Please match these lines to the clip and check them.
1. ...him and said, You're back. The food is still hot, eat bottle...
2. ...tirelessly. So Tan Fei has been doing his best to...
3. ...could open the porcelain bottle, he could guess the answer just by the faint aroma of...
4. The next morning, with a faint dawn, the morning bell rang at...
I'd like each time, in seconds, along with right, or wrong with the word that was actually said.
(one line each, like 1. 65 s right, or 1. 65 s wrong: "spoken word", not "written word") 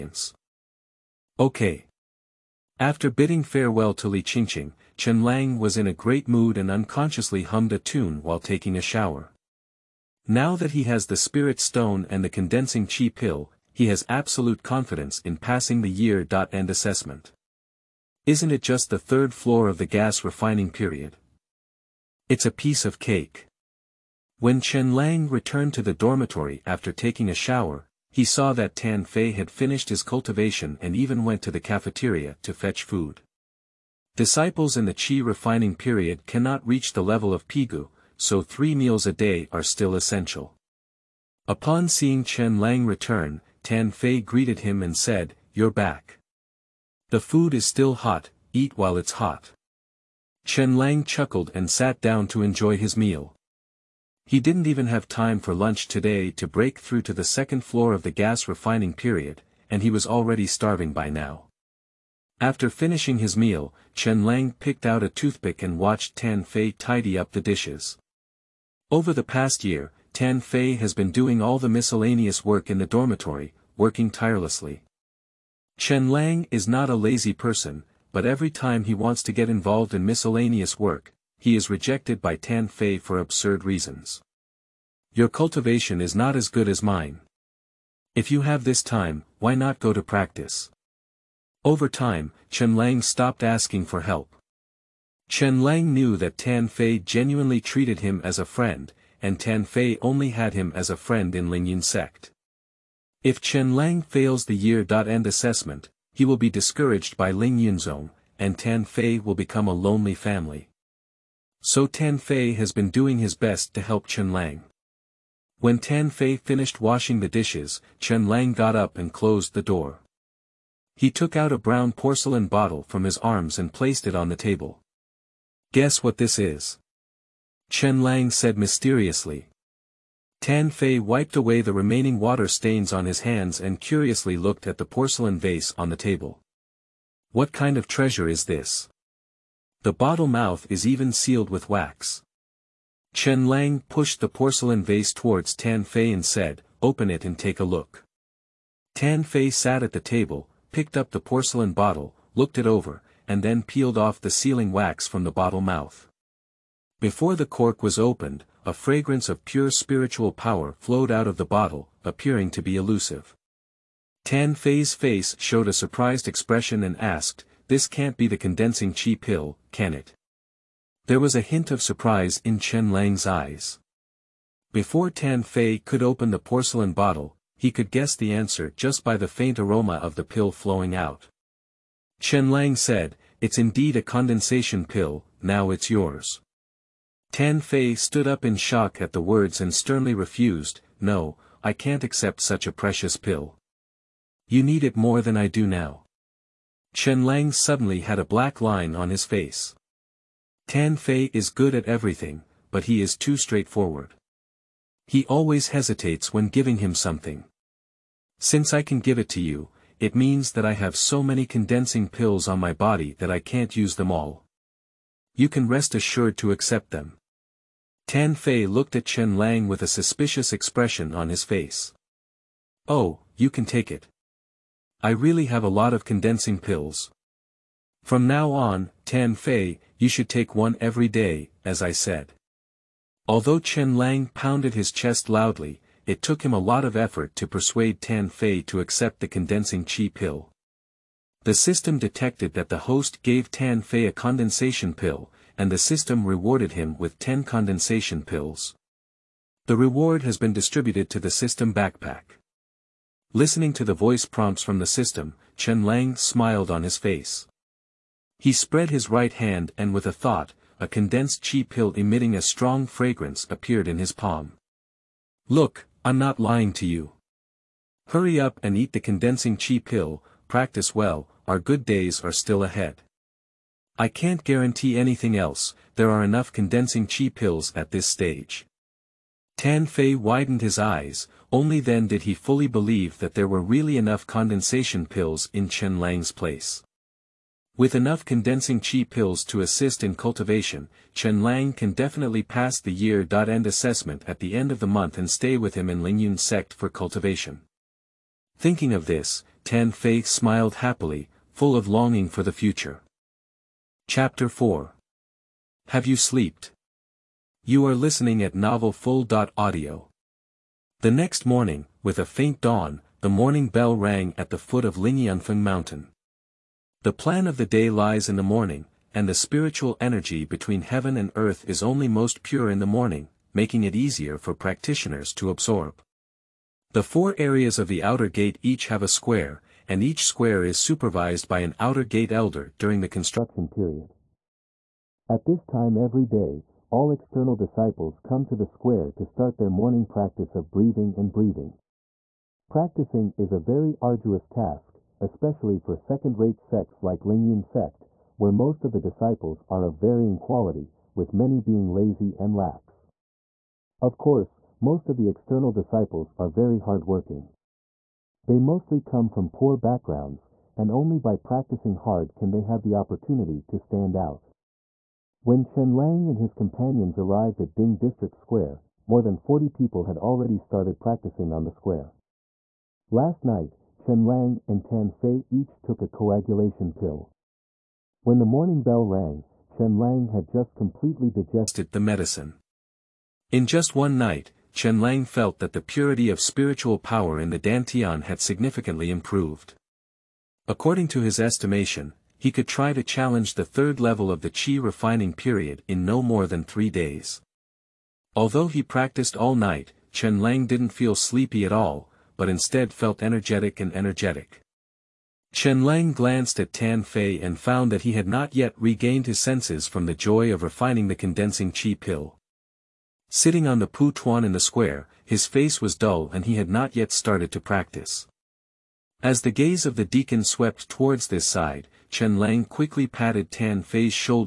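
1. 44 s wrong: "while", not "bottle"
2. 110 s wrong: "family", not "tirelessly"
3. 175 s right
4. 310 s right.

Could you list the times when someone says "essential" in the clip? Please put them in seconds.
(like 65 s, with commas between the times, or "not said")
39 s.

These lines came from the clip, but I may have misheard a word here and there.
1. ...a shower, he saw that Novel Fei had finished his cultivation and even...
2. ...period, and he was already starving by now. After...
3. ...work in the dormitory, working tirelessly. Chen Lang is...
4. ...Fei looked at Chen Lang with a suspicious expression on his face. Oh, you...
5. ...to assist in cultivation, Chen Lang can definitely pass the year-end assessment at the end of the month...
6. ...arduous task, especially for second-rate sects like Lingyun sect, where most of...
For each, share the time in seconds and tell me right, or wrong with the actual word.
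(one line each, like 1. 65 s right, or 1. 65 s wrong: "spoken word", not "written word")
1. 27 s wrong: "Tan", not "Novel"
2. 58 s right
3. 72 s right
4. 218 s right
5. 289 s right
6. 344 s right.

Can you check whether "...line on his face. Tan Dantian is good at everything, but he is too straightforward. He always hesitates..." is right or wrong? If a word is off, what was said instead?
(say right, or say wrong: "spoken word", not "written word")
wrong: "Fei", not "Dantian".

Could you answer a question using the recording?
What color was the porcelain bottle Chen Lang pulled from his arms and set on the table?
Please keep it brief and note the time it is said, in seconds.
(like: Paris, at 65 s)
Brown, at 121 s.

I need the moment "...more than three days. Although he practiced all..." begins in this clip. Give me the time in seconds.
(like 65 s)
396 s.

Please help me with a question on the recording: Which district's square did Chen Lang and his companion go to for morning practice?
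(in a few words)
Ding District.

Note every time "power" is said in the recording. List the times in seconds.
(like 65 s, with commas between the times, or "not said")
160 s, 386 s.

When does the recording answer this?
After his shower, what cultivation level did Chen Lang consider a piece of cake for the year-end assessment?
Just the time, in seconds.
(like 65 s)
18 s.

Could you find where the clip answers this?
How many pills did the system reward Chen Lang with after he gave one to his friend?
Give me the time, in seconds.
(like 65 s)
247 s.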